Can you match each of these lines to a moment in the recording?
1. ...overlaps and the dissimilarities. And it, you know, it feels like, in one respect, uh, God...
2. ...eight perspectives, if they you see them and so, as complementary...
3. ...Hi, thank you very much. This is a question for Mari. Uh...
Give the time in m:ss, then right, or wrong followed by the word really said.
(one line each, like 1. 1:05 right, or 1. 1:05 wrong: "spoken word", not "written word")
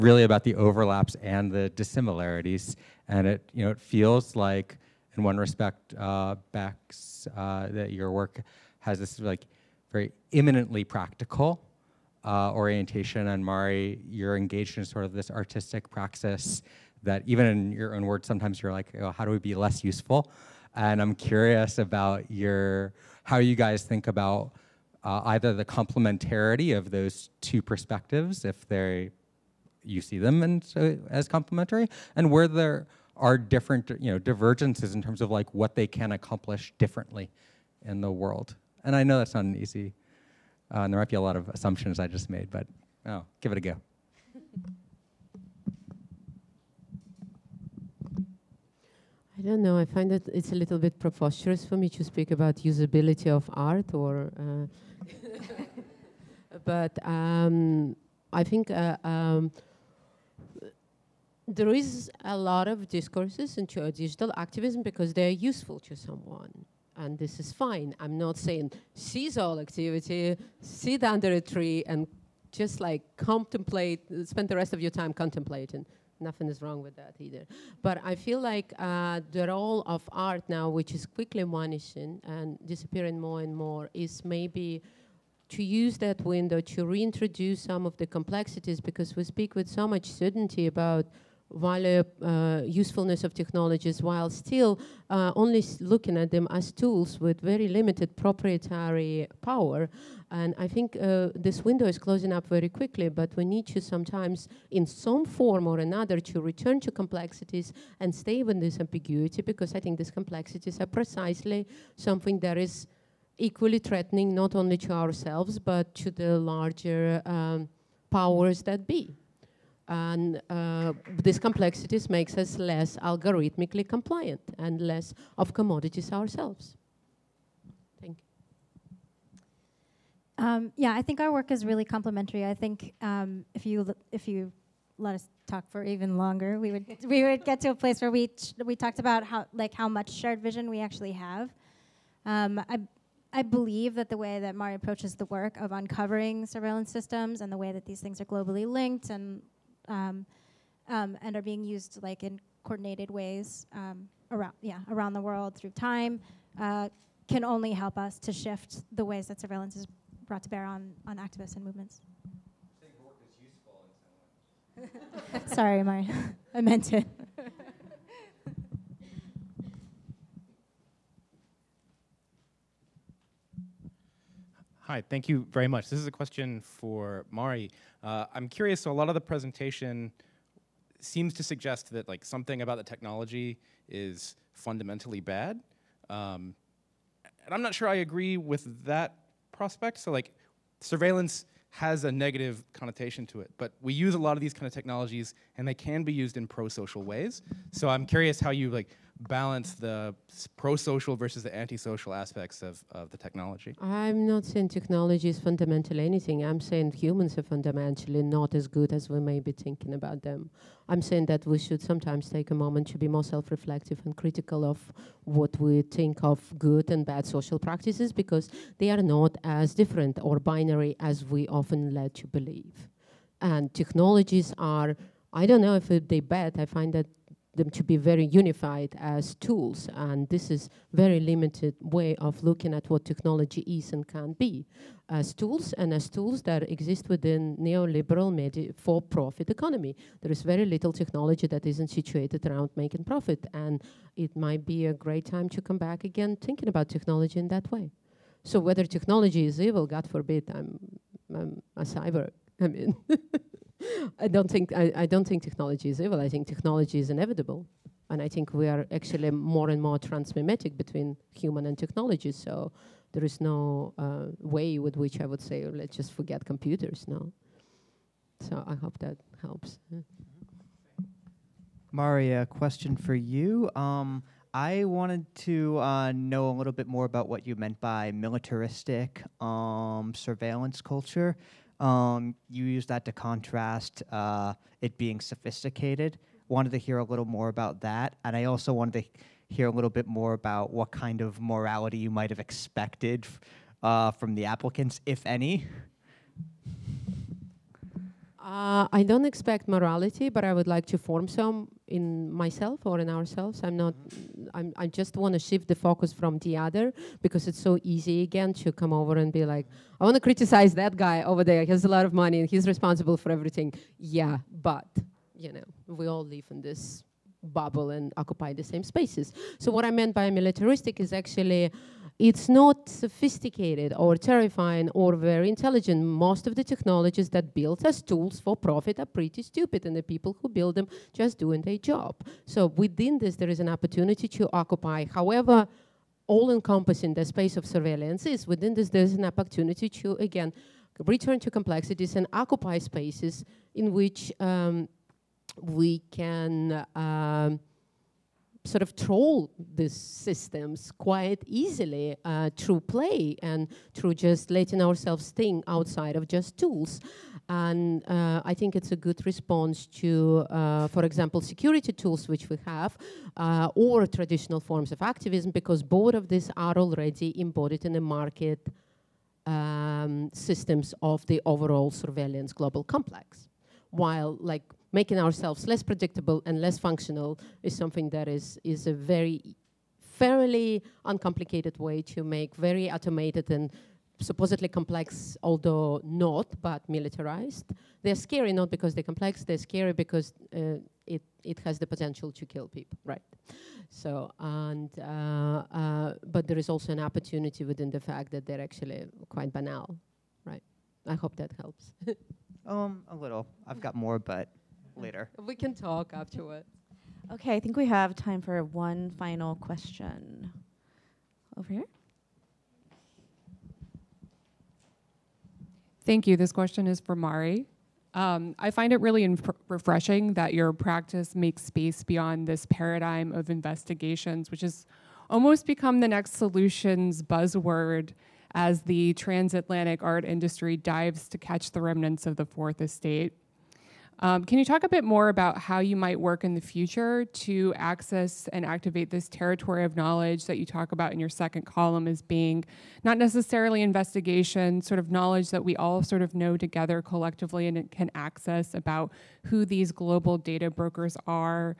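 1. 0:00 wrong: "Bex", not "God"
2. 0:27 wrong: "two", not "eight"
3. 2:54 right.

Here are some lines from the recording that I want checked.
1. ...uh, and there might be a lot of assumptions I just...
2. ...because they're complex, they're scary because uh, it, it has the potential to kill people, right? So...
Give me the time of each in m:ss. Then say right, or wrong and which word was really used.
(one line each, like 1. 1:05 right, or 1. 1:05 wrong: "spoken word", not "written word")
1. 0:40 right
2. 6:28 right.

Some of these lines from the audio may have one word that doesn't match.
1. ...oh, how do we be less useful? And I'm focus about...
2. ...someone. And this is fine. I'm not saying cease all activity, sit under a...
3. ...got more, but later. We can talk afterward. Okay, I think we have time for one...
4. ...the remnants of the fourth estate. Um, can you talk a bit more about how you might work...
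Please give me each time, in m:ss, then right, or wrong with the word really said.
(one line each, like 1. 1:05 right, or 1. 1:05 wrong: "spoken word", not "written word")
1. 0:18 wrong: "curious", not "focus"
2. 1:05 right
3. 6:43 right
4. 7:11 right.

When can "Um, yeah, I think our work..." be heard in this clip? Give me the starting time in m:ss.
2:10.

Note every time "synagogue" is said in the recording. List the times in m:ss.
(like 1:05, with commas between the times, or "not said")
not said.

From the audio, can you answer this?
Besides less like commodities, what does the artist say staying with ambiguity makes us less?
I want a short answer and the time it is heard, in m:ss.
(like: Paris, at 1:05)
algorithmically compliant, at 2:02.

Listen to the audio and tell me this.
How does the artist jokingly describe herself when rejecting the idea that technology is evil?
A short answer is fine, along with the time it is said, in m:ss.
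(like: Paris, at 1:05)
a cyber, at 4:11.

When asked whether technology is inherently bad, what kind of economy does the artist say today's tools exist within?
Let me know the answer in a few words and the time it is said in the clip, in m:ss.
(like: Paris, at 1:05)
neoliberal for-profit economy, at 3:57.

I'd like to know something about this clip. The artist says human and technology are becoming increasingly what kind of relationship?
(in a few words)
transmimetic.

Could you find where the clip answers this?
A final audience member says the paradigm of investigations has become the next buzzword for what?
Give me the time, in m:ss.
7:06.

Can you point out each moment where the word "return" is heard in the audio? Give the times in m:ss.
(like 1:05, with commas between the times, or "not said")
1:46, 5:41.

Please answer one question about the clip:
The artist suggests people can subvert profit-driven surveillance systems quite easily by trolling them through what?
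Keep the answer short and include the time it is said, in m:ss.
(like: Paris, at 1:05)
play, at 5:52.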